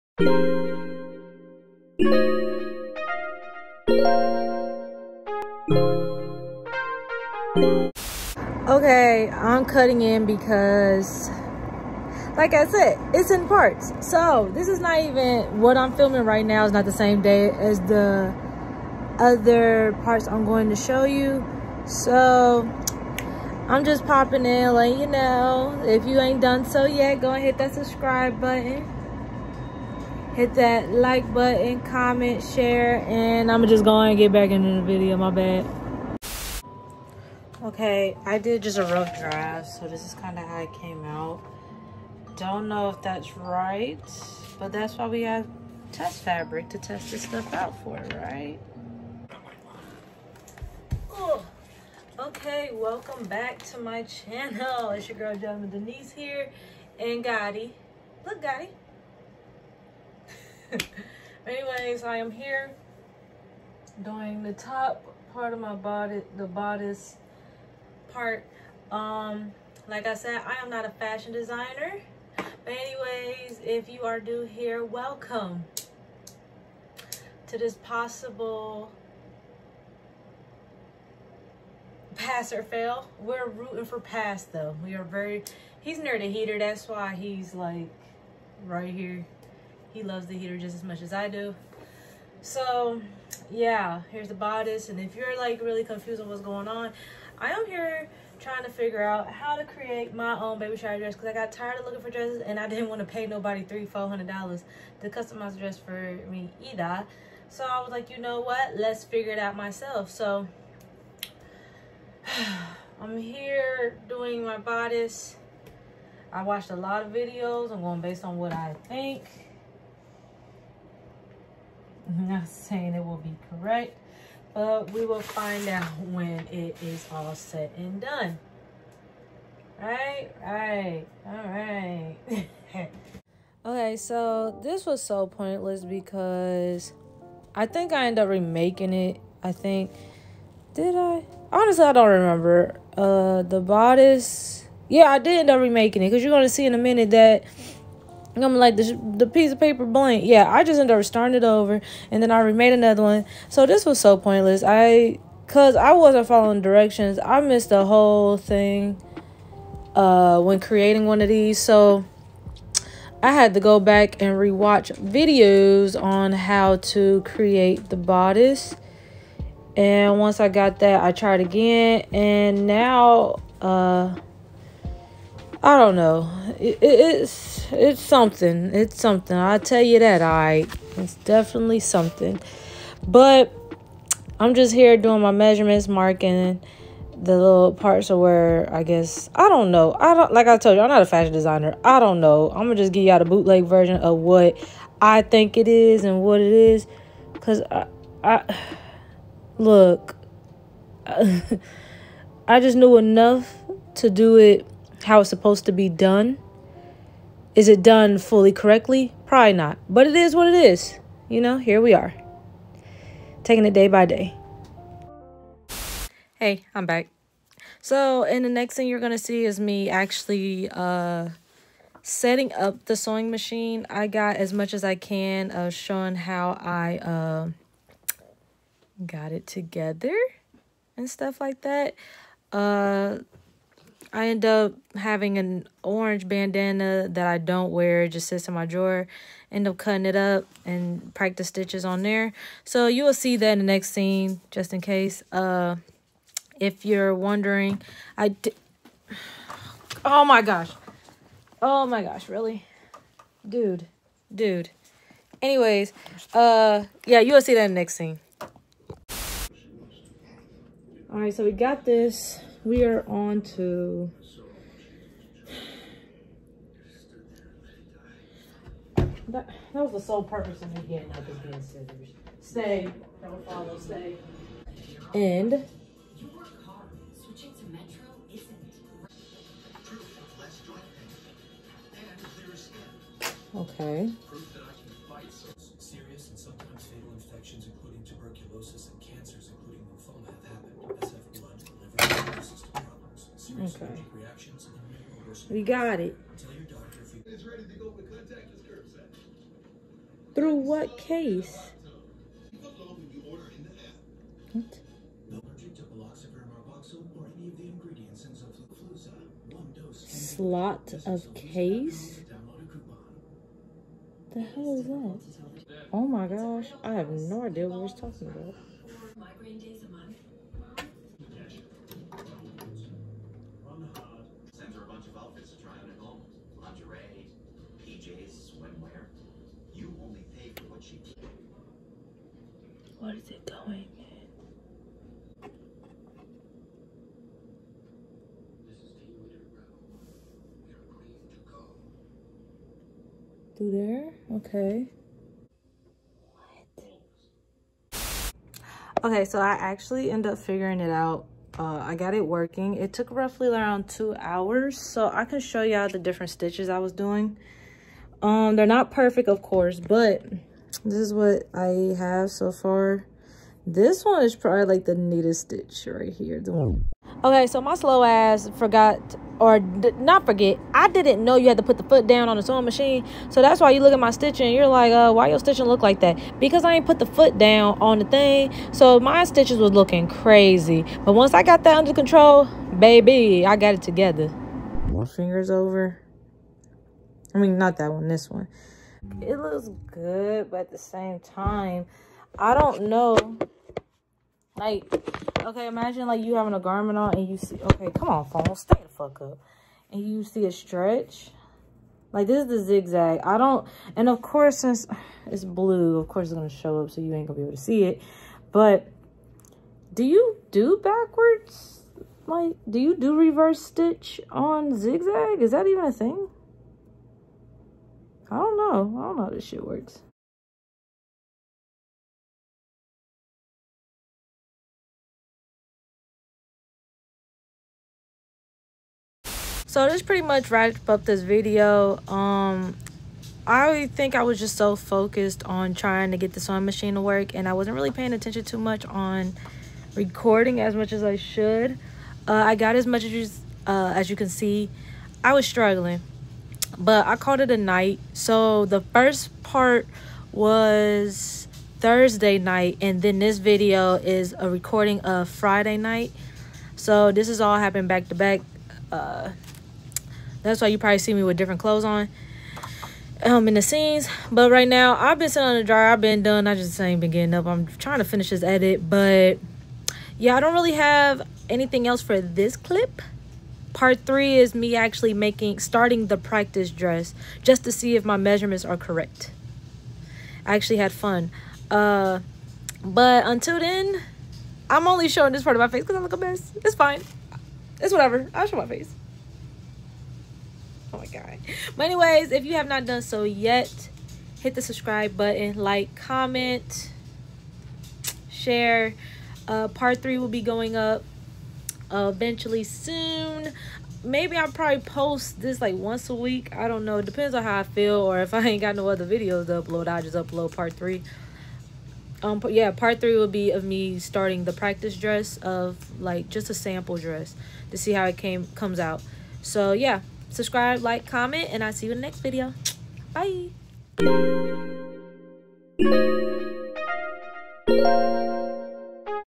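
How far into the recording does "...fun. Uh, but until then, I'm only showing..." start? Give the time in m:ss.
8:00.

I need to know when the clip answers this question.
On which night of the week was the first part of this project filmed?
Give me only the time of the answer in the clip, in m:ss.
7:31.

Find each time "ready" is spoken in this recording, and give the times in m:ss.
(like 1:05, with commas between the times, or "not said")
4:57.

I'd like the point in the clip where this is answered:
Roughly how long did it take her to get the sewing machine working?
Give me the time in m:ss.
5:53.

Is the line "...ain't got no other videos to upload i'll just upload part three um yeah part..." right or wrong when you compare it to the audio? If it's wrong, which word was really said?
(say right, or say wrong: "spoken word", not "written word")
right.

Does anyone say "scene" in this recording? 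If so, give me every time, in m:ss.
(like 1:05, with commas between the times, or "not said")
4:03, 4:17, 7:43.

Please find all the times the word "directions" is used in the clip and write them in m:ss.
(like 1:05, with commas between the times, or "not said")
2:36.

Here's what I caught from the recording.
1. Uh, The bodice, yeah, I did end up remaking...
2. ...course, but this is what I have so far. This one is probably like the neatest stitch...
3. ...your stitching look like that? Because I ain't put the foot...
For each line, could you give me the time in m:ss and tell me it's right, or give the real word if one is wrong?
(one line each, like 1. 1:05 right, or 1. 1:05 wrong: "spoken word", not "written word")
1. 2:22 right
2. 5:59 right
3. 6:15 right.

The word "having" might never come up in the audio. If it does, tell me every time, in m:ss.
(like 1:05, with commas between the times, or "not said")
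3:54, 6:36.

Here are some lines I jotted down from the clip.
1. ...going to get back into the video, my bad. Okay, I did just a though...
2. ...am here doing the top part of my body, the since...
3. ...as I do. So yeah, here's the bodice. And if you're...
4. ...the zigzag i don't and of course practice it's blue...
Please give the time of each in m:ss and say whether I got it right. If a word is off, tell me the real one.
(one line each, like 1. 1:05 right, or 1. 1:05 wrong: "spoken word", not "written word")
1. 0:33 wrong: "rough", not "though"
2. 1:02 wrong: "bodice", not "since"
3. 1:31 right
4. 6:42 wrong: "since", not "practice".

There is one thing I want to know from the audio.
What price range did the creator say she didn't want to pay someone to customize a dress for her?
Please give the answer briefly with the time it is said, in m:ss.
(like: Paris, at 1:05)
300 to 400 dollars, at 1:43.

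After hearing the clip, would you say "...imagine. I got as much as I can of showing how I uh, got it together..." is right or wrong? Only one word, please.
wrong.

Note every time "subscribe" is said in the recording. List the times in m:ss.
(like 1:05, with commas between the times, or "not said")
0:27, 8:14, 8:40.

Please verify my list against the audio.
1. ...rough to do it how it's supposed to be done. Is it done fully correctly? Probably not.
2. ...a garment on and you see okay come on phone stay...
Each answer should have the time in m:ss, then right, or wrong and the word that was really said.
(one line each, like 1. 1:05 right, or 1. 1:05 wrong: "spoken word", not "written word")
1. 3:22 wrong: "enough", not "rough"
2. 6:36 right.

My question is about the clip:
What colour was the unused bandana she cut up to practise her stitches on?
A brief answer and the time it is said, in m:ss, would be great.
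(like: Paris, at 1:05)
Orange, at 3:55.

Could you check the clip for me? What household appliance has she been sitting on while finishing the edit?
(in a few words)
The dryer.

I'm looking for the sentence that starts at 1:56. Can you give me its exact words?
I watched a lot of videos.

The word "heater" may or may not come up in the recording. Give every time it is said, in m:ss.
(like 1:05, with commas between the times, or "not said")
1:26, 1:30.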